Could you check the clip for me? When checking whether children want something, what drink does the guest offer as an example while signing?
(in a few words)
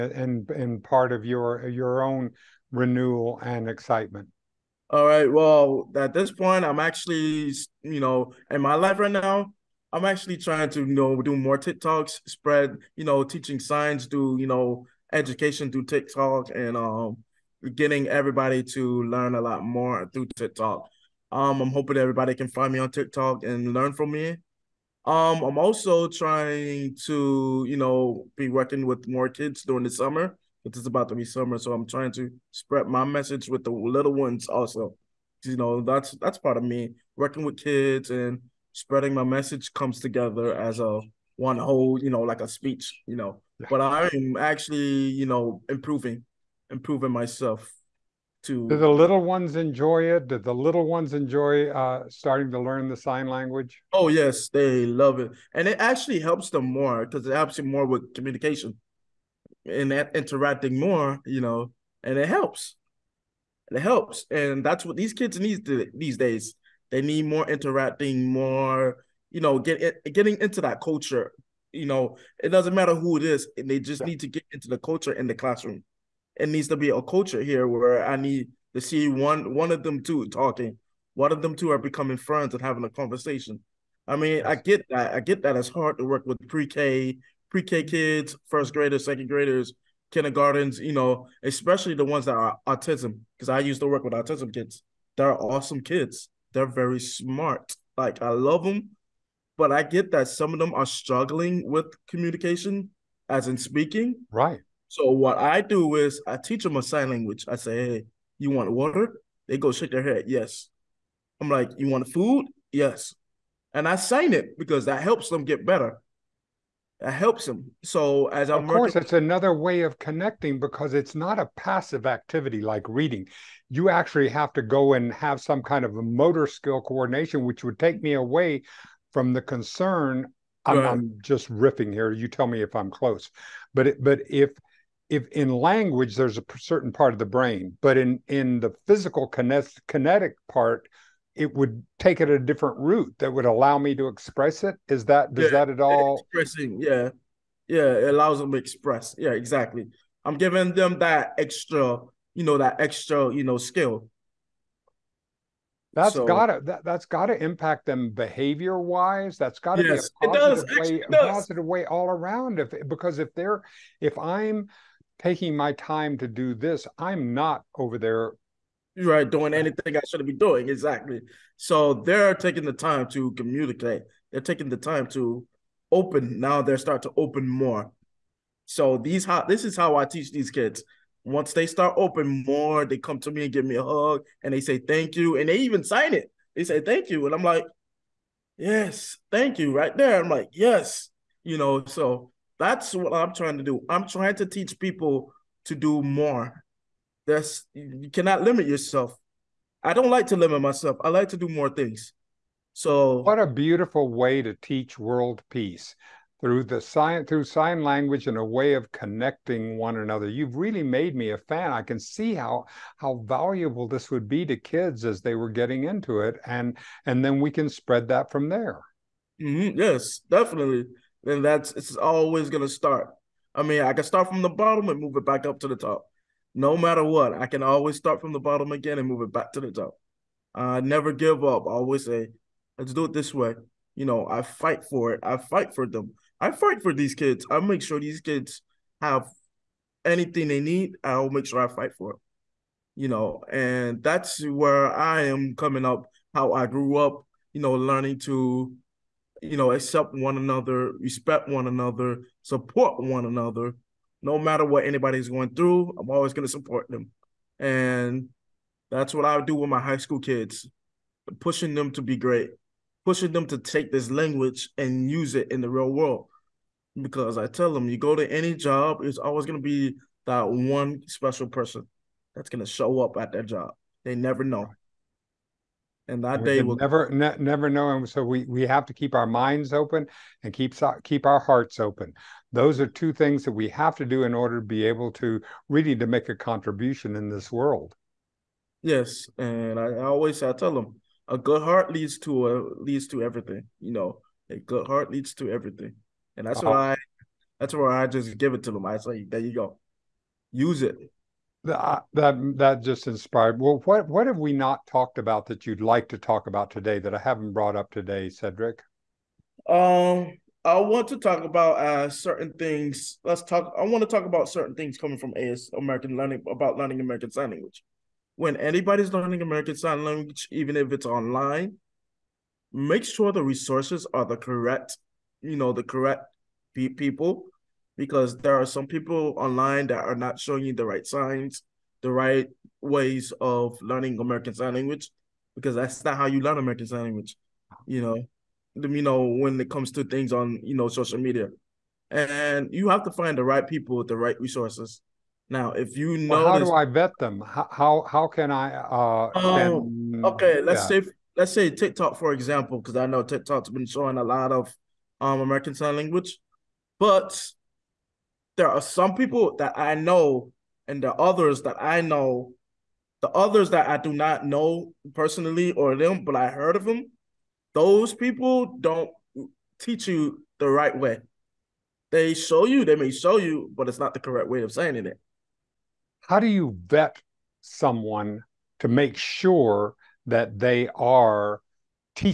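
water.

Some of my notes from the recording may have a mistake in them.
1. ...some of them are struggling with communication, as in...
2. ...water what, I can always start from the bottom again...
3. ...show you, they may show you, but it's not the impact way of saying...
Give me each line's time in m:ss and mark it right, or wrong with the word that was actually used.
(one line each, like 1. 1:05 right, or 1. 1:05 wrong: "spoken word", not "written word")
1. 1:40 right
2. 3:46 wrong: "matter", not "water"
3. 6:12 wrong: "correct", not "impact".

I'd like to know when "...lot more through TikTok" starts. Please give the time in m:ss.
0:19.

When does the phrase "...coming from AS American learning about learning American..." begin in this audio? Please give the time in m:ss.
5:14.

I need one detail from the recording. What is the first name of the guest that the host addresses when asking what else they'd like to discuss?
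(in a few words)
Cedric.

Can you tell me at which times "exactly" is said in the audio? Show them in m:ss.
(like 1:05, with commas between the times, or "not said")
2:29, 2:50.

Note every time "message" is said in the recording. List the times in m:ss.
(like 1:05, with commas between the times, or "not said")
0:33, 0:39.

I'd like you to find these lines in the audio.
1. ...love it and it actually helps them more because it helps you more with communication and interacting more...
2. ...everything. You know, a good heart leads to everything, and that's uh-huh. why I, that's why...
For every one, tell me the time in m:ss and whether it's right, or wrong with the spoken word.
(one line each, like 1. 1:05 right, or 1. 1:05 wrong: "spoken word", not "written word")
1. 0:54 right
2. 4:53 right.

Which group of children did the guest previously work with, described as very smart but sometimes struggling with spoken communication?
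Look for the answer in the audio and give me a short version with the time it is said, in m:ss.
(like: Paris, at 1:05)
autism kids, at 1:34.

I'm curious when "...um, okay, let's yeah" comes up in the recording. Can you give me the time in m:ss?
5:49.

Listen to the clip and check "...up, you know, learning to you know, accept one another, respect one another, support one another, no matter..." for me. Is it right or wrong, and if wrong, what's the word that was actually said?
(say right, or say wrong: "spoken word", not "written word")
right.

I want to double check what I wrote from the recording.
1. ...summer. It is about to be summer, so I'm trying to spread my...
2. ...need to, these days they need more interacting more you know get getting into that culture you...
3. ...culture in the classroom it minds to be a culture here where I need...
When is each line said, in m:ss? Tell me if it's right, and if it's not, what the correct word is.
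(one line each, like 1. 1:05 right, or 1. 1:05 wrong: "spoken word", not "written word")
1. 0:29 right
2. 1:05 right
3. 1:14 wrong: "needs", not "minds".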